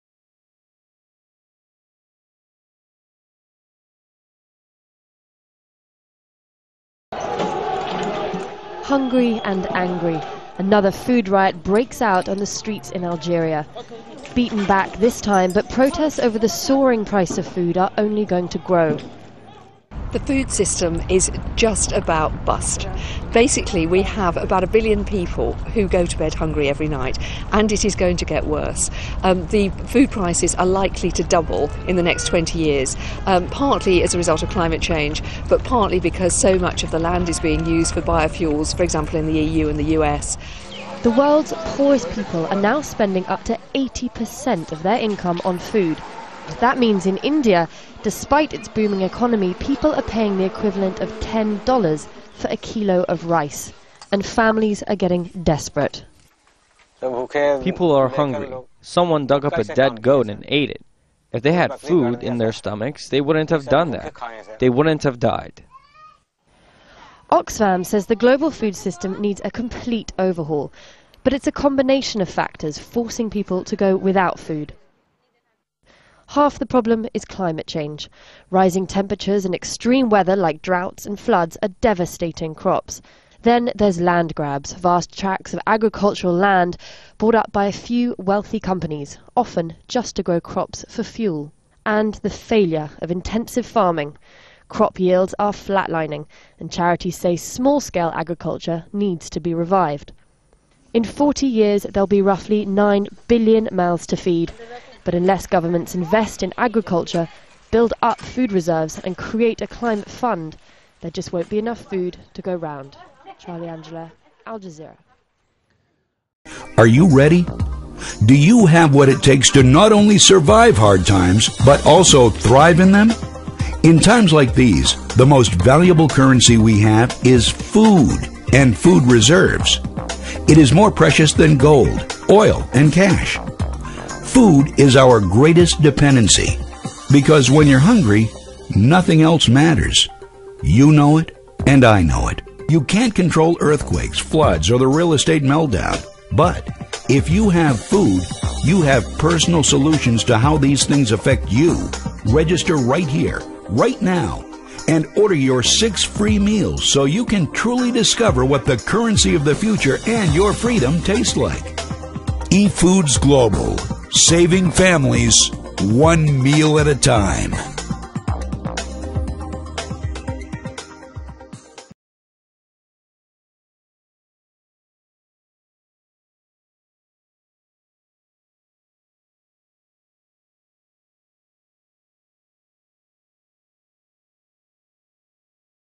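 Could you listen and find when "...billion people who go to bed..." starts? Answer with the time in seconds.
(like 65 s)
24 s.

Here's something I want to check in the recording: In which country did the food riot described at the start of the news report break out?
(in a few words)
Algeria.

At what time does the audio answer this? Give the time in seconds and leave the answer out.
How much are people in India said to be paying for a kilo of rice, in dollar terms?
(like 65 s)
51 s.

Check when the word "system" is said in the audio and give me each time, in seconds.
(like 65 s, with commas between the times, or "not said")
20 s, 68 s.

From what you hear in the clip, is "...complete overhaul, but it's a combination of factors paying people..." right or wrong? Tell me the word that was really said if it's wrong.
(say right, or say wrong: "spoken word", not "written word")
wrong: "forcing", not "paying".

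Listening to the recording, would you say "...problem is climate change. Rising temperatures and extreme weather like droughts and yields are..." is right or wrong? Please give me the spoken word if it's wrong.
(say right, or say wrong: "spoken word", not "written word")
wrong: "floods", not "yields".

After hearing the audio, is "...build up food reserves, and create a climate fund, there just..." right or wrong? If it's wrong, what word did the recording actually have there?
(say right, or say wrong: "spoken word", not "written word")
right.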